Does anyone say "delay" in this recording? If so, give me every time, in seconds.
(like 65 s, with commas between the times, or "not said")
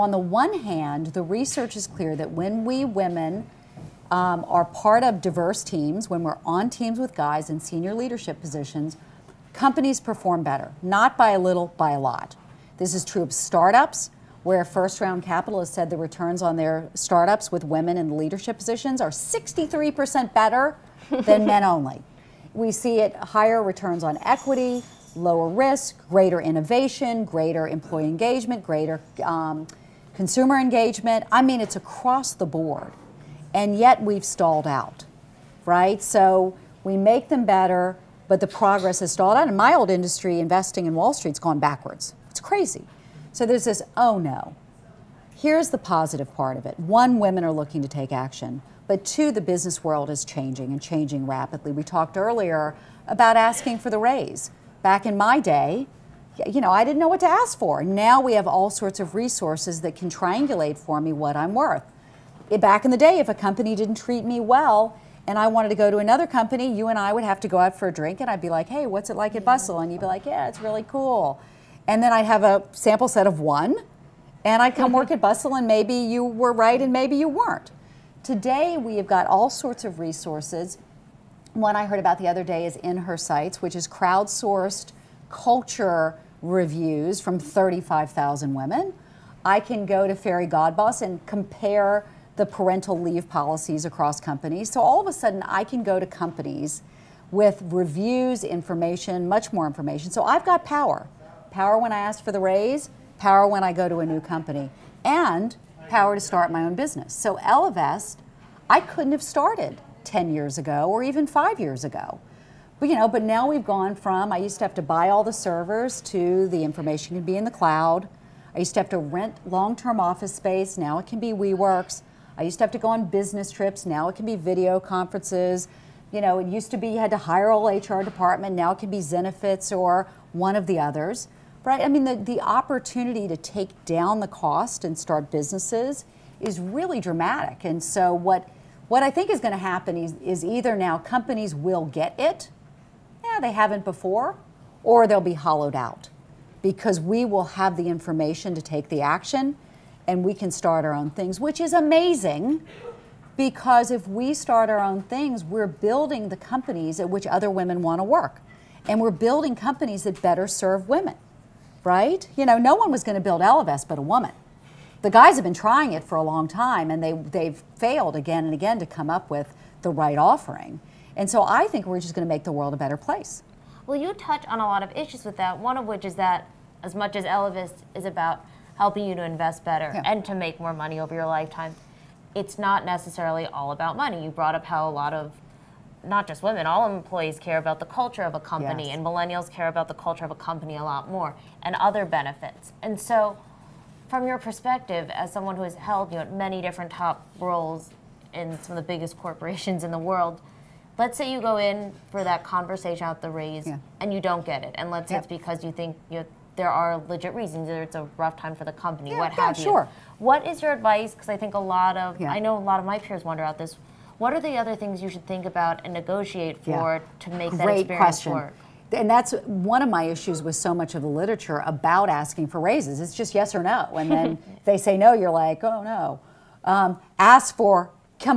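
not said.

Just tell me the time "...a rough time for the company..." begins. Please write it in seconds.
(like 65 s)
207 s.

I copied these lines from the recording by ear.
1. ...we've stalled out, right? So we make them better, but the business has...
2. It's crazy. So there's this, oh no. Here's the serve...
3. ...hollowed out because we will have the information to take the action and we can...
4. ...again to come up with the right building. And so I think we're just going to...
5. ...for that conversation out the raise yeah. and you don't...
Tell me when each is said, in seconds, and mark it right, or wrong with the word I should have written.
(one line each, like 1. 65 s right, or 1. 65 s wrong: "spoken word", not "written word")
1. 34 s wrong: "progress", not "business"
2. 42 s wrong: "positive", not "serve"
3. 145 s right
4. 168 s wrong: "offering", not "building"
5. 202 s right.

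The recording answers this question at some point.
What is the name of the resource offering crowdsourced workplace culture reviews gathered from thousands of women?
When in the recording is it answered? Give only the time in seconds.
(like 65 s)
82 s.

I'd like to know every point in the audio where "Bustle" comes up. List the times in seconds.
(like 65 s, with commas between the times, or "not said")
69 s, 75 s.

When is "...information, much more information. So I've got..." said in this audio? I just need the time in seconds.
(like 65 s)
98 s.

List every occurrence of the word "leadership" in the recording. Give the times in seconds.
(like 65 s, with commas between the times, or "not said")
7 s, 18 s.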